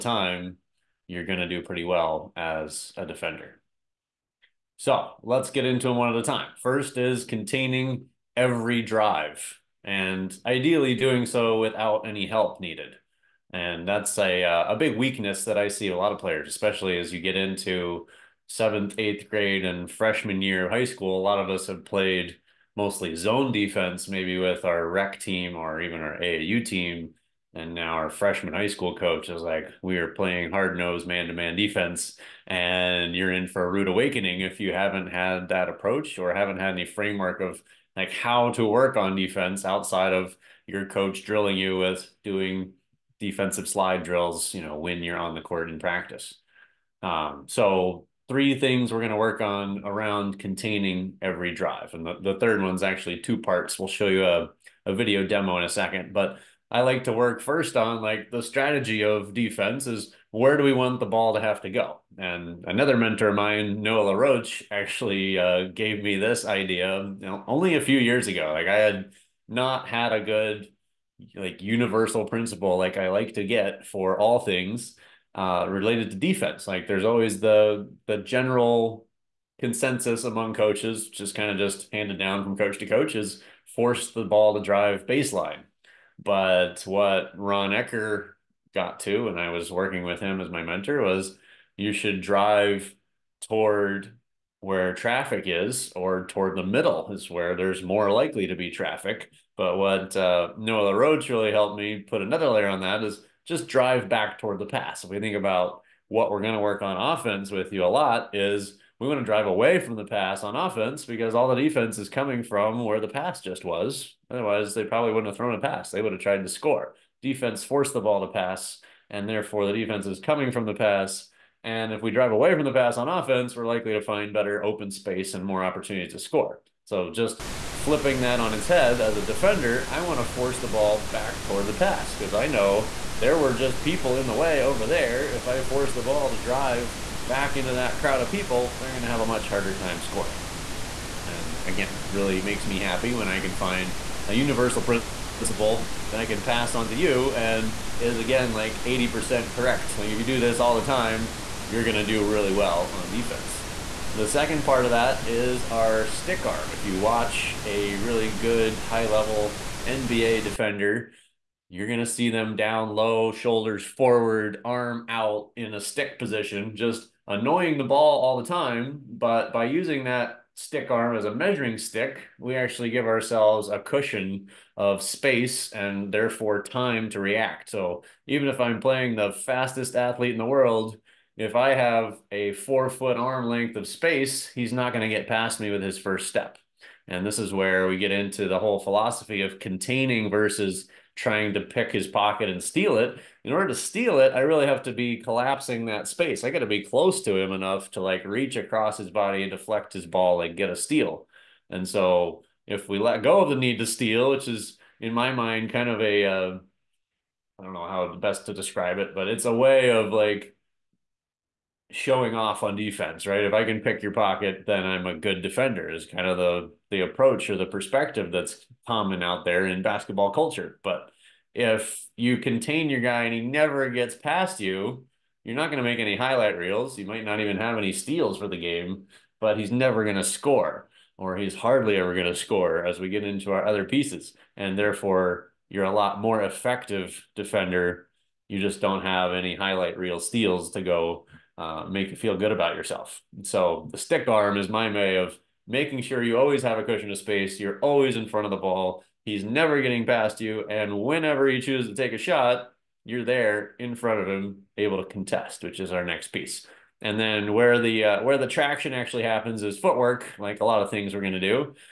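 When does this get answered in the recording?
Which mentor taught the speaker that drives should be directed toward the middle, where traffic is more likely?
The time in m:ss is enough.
1:27.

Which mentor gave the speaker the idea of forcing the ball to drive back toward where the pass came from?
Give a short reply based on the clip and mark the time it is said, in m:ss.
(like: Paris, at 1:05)
Noah LaRoche, at 1:03.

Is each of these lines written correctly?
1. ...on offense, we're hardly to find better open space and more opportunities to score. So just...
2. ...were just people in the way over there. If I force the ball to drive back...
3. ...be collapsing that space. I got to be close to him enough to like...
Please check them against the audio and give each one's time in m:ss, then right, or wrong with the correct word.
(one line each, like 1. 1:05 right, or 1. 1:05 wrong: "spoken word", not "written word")
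1. 2:02 wrong: "likely", not "hardly"
2. 2:13 right
3. 3:14 right.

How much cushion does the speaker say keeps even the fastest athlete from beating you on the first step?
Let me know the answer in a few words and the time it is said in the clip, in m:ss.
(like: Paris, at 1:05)
4 feet, at 3:02.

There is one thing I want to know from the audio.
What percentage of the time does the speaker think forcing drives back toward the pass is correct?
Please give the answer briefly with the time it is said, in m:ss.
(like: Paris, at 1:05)
80%, at 2:28.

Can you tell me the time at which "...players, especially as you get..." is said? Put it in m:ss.
0:16.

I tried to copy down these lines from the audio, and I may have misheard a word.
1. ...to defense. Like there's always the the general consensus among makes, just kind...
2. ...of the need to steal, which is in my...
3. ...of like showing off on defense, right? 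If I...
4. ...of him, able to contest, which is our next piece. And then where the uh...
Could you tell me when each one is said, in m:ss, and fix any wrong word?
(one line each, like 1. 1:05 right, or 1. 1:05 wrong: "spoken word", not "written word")
1. 1:16 wrong: "coaches", not "makes"
2. 3:23 right
3. 3:29 right
4. 4:14 right.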